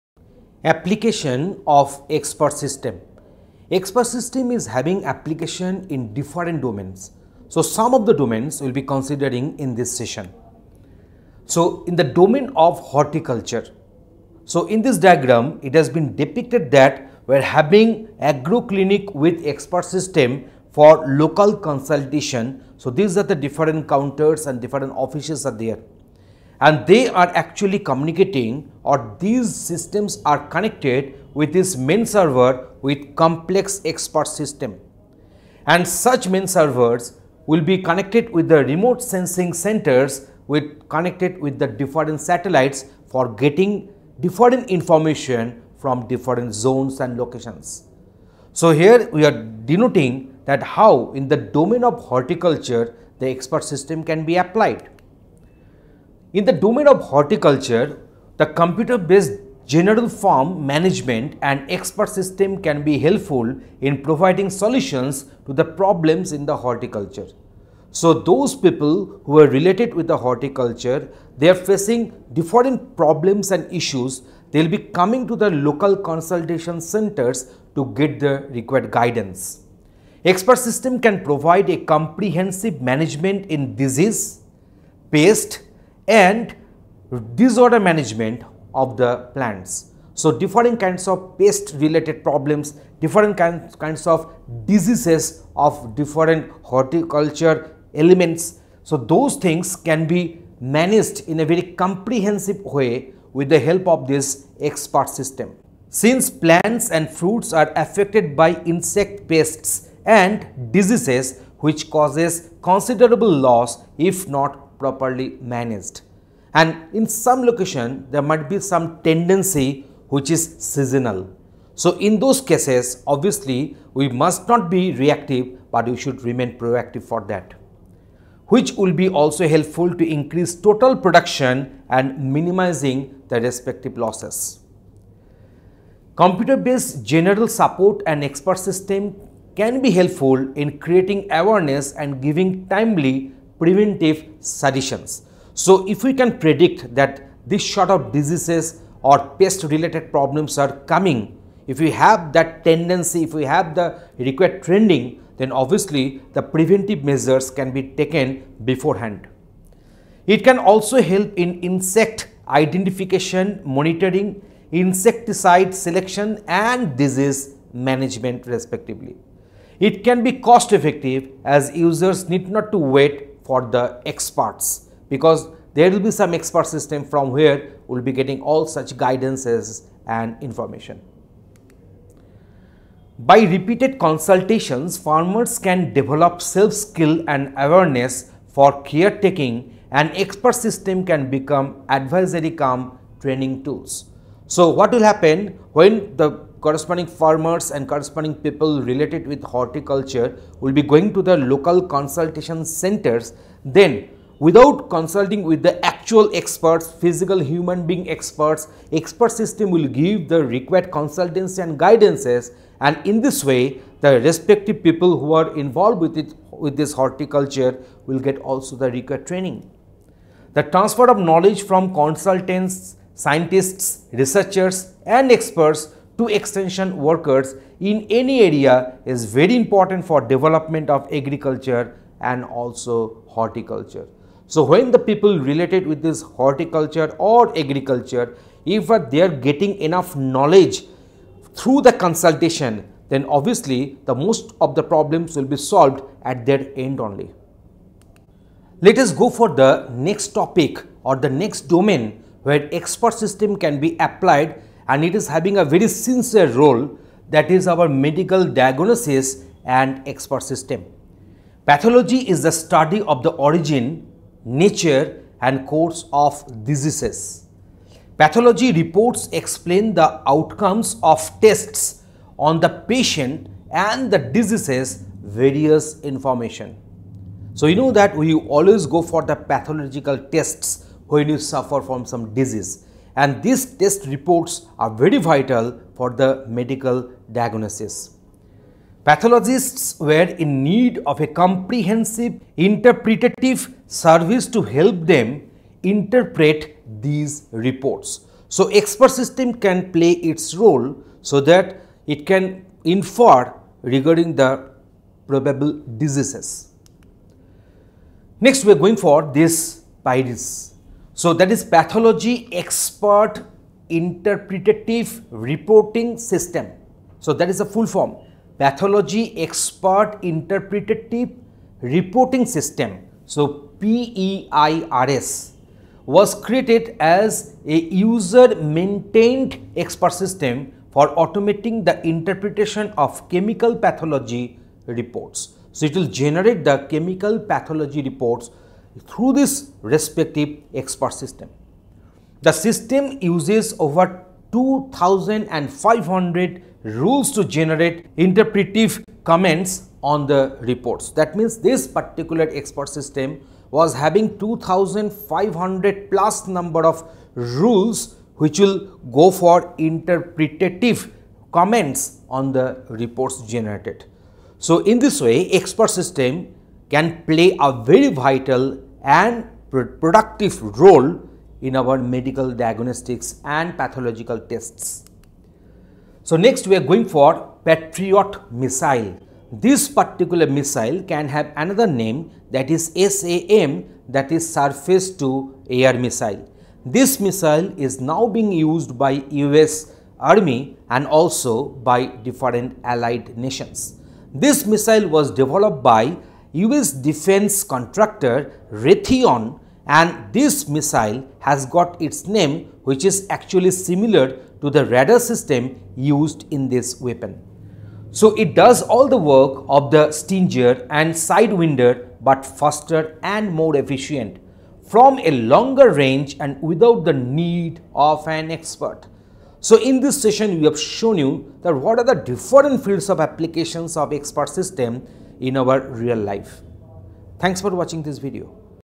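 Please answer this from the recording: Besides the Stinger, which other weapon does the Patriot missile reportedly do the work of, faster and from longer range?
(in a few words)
Sidewinder.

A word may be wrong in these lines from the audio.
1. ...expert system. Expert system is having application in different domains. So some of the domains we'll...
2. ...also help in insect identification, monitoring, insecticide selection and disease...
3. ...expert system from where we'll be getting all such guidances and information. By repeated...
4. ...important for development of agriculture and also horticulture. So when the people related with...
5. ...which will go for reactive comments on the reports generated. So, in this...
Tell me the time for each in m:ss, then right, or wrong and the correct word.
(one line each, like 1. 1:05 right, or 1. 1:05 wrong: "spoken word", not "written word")
1. 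0:02 right
2. 2:40 right
3. 2:56 right
4. 3:49 right
5. 5:58 wrong: "interpretative", not "reactive".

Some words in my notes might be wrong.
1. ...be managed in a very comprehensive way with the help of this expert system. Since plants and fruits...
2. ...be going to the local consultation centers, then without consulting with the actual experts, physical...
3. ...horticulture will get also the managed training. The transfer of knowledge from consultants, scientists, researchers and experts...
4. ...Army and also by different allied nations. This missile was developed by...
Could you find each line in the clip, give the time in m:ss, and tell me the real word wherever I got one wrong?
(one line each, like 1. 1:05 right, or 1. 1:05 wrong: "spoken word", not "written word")
1. 1:40 right
2. 3:20 right
3. 3:36 wrong: "required", not "managed"
4. 6:30 right.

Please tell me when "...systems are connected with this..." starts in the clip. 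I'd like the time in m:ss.
0:29.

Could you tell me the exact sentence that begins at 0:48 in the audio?
So, here we are denoting that how in the domain of horticulture the expert system can be applied.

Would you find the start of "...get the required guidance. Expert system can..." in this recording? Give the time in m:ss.
1:17.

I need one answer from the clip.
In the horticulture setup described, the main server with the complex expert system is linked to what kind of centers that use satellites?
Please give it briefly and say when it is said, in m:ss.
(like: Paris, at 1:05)
remote sensing centers, at 0:38.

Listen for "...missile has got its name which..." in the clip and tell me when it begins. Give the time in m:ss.
6:40.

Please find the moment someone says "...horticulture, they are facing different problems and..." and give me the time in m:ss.
1:10.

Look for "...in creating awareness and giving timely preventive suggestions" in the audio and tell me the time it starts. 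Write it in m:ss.
2:20.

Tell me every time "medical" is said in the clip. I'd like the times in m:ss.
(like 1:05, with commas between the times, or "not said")
4:17, 4:46, 6:11.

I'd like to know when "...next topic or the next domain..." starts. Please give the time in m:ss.
4:09.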